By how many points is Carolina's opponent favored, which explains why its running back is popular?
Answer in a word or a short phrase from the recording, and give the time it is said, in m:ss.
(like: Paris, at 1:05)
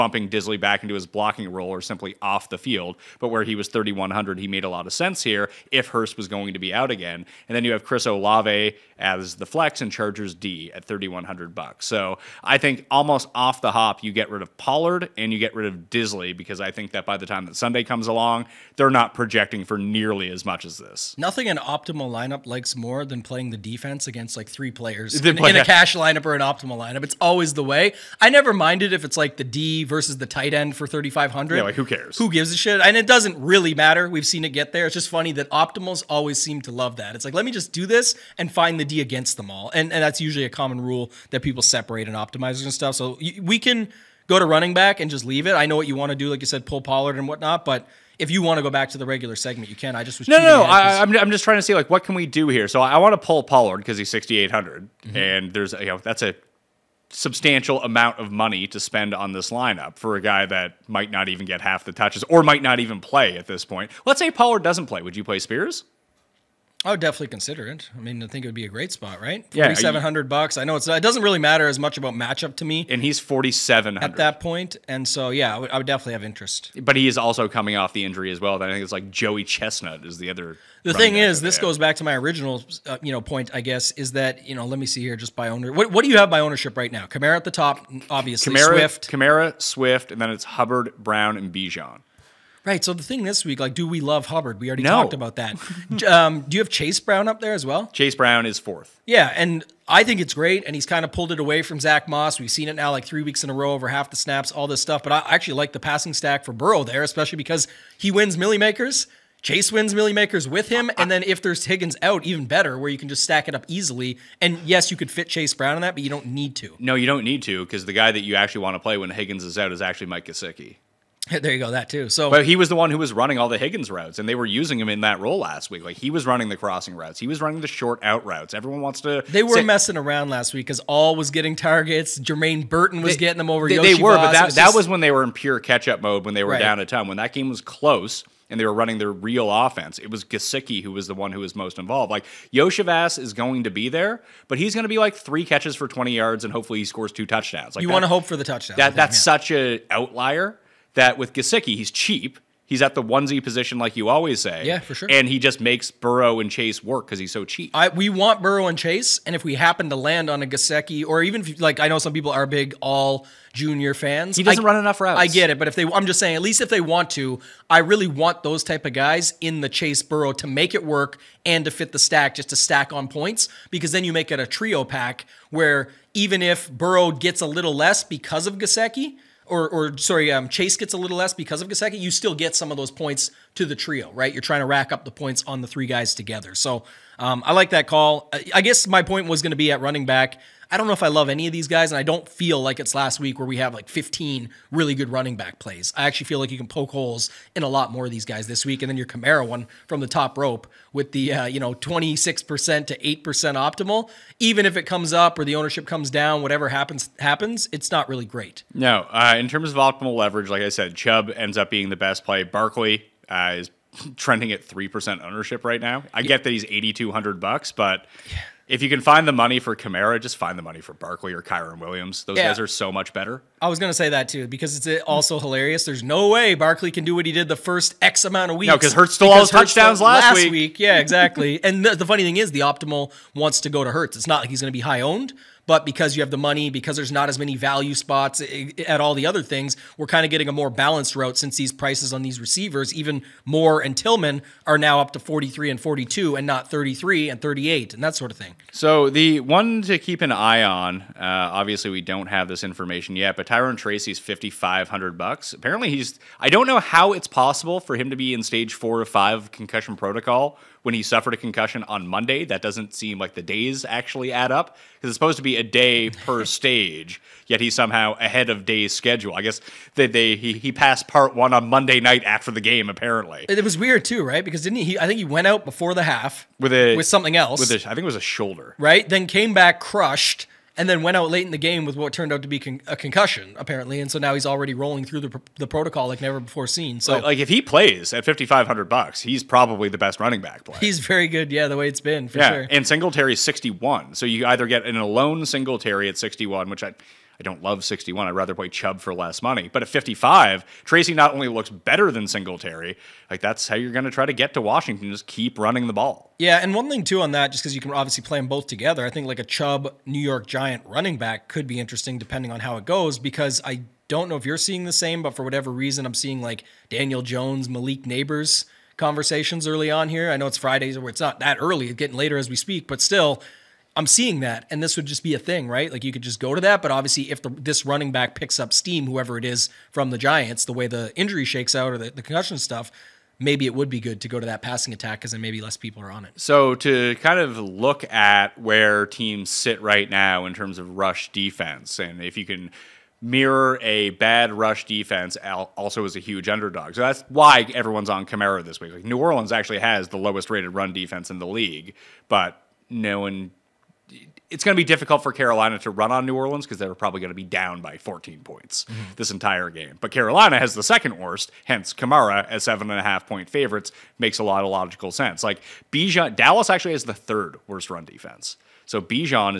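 7.5, at 6:02.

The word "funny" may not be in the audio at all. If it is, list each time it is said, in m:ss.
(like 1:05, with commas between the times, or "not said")
0:35, 3:52.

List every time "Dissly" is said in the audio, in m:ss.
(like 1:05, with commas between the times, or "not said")
0:00, 0:15.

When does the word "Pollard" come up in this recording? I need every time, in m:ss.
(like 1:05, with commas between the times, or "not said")
0:14, 0:46, 0:53, 1:04.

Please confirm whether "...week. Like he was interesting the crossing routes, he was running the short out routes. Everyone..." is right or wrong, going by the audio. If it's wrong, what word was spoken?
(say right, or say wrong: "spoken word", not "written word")
wrong: "running", not "interesting".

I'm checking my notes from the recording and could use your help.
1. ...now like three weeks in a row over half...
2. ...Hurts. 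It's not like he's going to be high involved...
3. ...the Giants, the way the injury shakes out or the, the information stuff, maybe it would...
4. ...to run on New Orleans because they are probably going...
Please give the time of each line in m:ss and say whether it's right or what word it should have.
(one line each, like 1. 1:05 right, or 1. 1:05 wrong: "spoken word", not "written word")
1. 1:42 right
2. 3:53 wrong: "owned", not "involved"
3. 5:30 wrong: "concussion", not "information"
4. 5:55 right.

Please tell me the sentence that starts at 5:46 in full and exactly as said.
So that's why everyone's on Kamara this week.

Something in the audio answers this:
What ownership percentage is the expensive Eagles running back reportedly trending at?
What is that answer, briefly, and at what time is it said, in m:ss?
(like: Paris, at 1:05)
3%, at 3:34.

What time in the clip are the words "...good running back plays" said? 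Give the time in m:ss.
3:14.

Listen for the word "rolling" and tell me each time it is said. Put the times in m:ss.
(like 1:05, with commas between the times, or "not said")
4:44.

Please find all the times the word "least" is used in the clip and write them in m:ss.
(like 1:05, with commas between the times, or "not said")
2:46.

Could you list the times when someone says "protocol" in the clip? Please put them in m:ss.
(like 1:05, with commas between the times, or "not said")
4:19, 4:45.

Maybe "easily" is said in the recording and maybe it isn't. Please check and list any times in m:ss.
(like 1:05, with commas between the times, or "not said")
1:53.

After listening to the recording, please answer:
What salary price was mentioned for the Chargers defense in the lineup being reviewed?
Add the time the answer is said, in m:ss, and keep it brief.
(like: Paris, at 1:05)
$3,100, at 0:10.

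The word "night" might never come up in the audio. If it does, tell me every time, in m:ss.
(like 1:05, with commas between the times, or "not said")
4:31.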